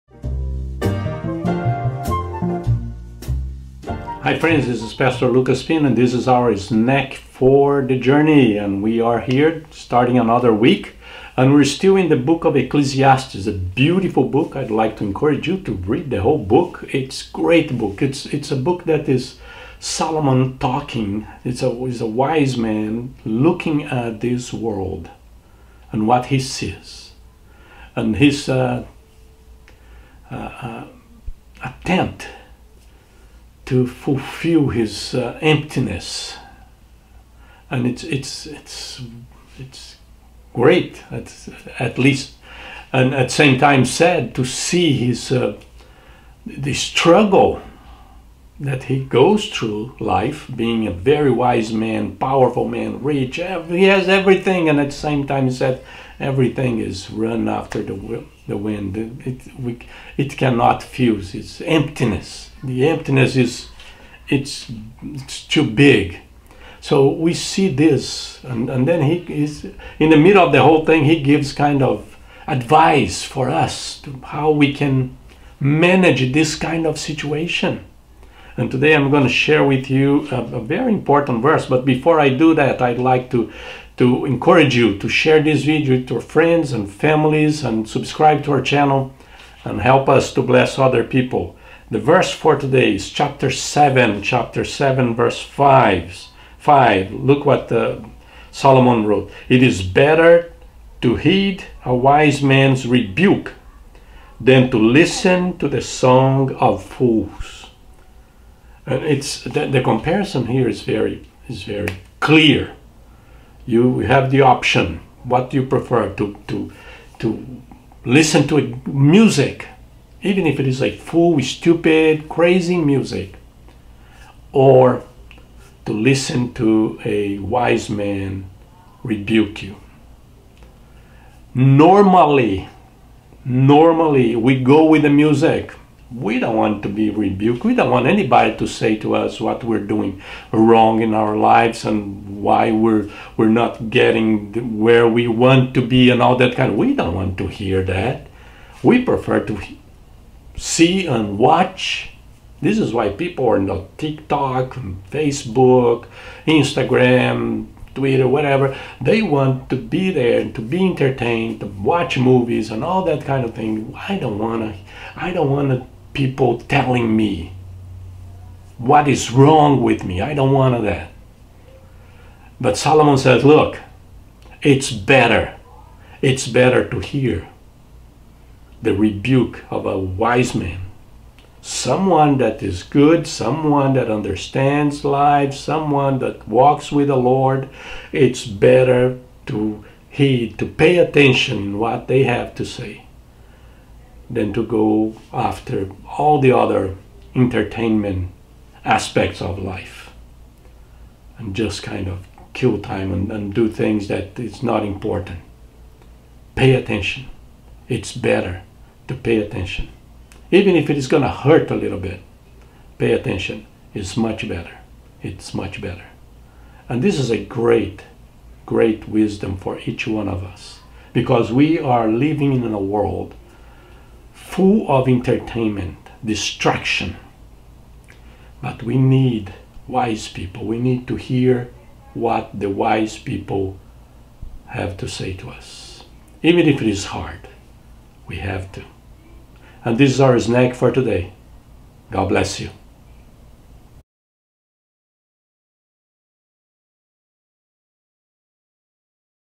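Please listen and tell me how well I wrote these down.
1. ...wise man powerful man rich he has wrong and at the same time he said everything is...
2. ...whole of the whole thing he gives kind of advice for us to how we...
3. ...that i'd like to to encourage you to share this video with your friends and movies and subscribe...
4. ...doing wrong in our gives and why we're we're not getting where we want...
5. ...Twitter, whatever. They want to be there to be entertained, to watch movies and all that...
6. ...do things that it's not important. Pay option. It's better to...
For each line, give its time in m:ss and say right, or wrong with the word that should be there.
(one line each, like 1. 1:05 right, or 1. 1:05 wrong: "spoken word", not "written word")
1. 0:51 wrong: "everything", not "wrong"
2. 1:10 wrong: "middle", not "whole"
3. 1:22 wrong: "families", not "movies"
4. 2:19 wrong: "lives", not "gives"
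5. 2:37 right
6. 3:23 wrong: "attention", not "option".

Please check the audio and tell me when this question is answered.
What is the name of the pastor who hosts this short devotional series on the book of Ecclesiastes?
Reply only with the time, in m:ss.
0:05.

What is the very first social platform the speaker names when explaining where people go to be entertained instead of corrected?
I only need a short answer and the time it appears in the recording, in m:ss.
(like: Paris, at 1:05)
TikTok, at 2:33.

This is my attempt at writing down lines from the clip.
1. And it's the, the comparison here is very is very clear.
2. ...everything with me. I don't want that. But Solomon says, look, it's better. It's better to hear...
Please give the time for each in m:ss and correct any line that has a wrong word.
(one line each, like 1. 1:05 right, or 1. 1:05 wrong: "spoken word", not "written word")
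1. 1:48 right
2. 2:49 wrong: "wrong", not "everything".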